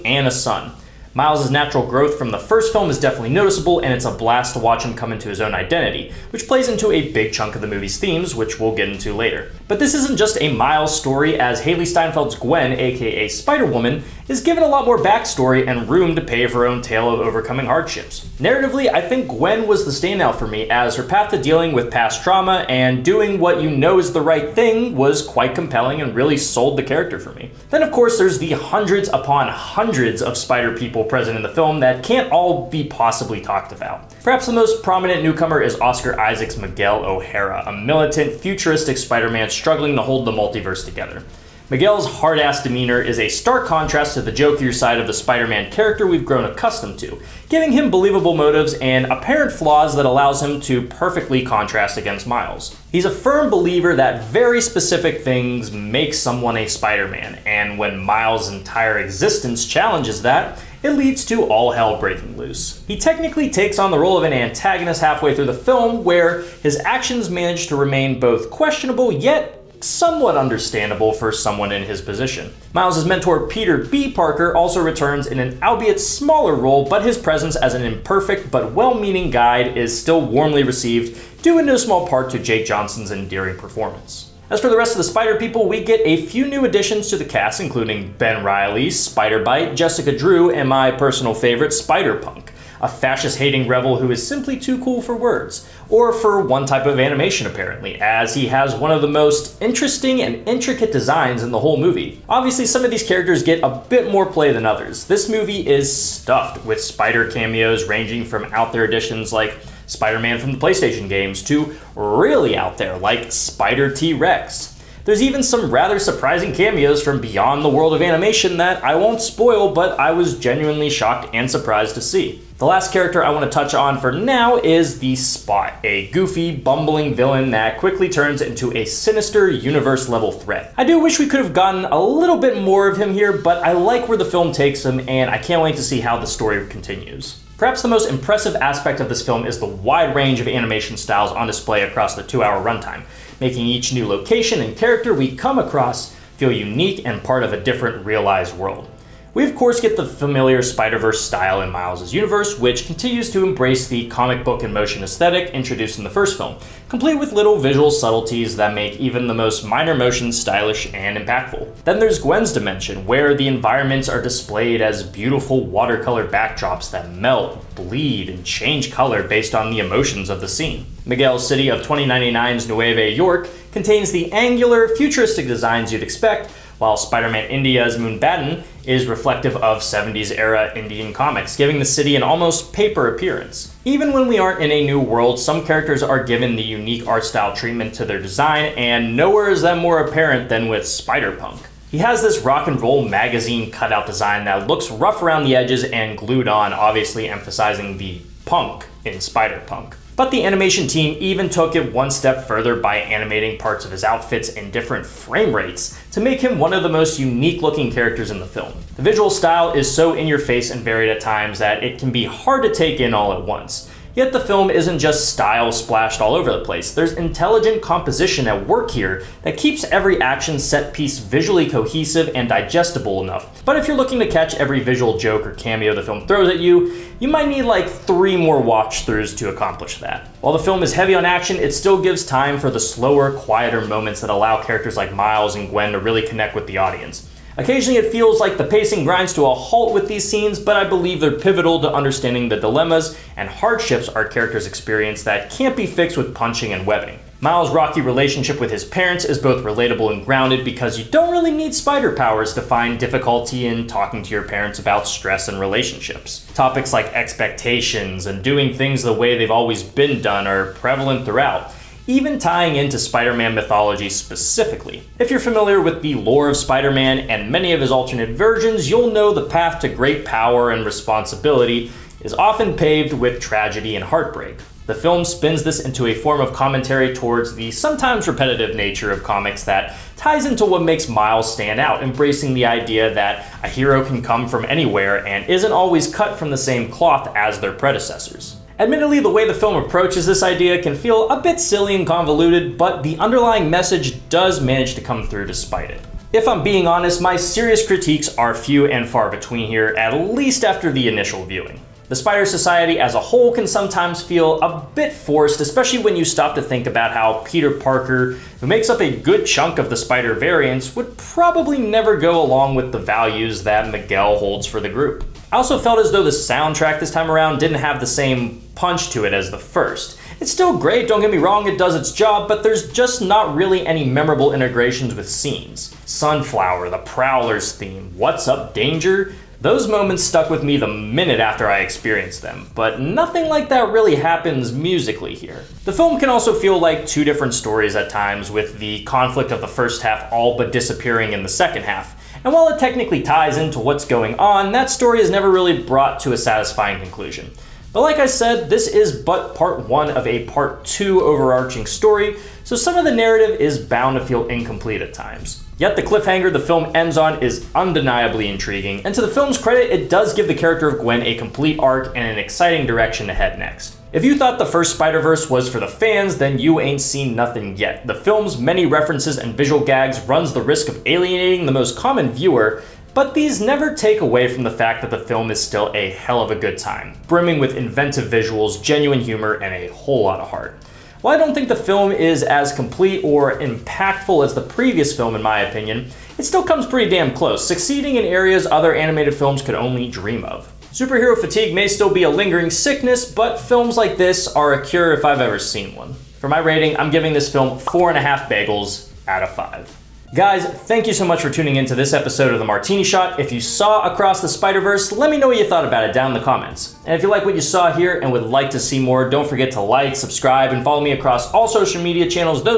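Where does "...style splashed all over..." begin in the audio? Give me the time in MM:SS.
03:35.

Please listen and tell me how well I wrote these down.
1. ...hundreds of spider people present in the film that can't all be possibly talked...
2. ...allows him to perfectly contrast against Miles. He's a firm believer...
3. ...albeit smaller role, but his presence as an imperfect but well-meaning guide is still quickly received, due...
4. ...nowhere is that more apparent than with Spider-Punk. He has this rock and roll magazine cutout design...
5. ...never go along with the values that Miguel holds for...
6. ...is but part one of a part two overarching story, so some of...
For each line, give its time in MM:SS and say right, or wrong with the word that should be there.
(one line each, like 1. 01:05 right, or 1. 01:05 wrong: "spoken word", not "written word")
1. 00:29 right
2. 00:50 right
3. 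01:15 wrong: "warmly", not "quickly"
4. 03:09 right
5. 05:11 right
6. 05:48 right.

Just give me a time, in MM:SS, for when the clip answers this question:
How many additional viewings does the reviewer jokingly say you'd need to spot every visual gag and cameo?
03:47.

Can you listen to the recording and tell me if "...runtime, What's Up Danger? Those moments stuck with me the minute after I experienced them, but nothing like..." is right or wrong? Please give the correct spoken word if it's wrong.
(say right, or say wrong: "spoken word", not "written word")
wrong: "theme", not "runtime".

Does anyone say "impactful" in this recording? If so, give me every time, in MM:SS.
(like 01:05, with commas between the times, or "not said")
02:41, 06:23.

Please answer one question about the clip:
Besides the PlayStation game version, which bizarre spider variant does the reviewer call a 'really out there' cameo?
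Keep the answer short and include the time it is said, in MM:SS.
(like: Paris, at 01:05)
Spider T-Rex, at 01:53.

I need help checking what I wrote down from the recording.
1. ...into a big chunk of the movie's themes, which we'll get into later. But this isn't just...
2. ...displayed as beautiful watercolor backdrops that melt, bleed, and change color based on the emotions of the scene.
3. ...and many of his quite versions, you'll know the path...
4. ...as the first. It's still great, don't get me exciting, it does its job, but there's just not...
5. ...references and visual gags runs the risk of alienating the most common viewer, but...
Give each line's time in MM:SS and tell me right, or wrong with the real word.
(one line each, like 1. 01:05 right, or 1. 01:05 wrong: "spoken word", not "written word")
1. 00:06 right
2. 02:44 right
3. 04:27 wrong: "alternate", not "quite"
4. 05:19 wrong: "wrong", not "exciting"
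5. 06:08 right.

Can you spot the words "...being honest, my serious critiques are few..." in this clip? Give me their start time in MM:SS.
04:56.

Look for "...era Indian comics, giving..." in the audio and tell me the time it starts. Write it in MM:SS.
03:00.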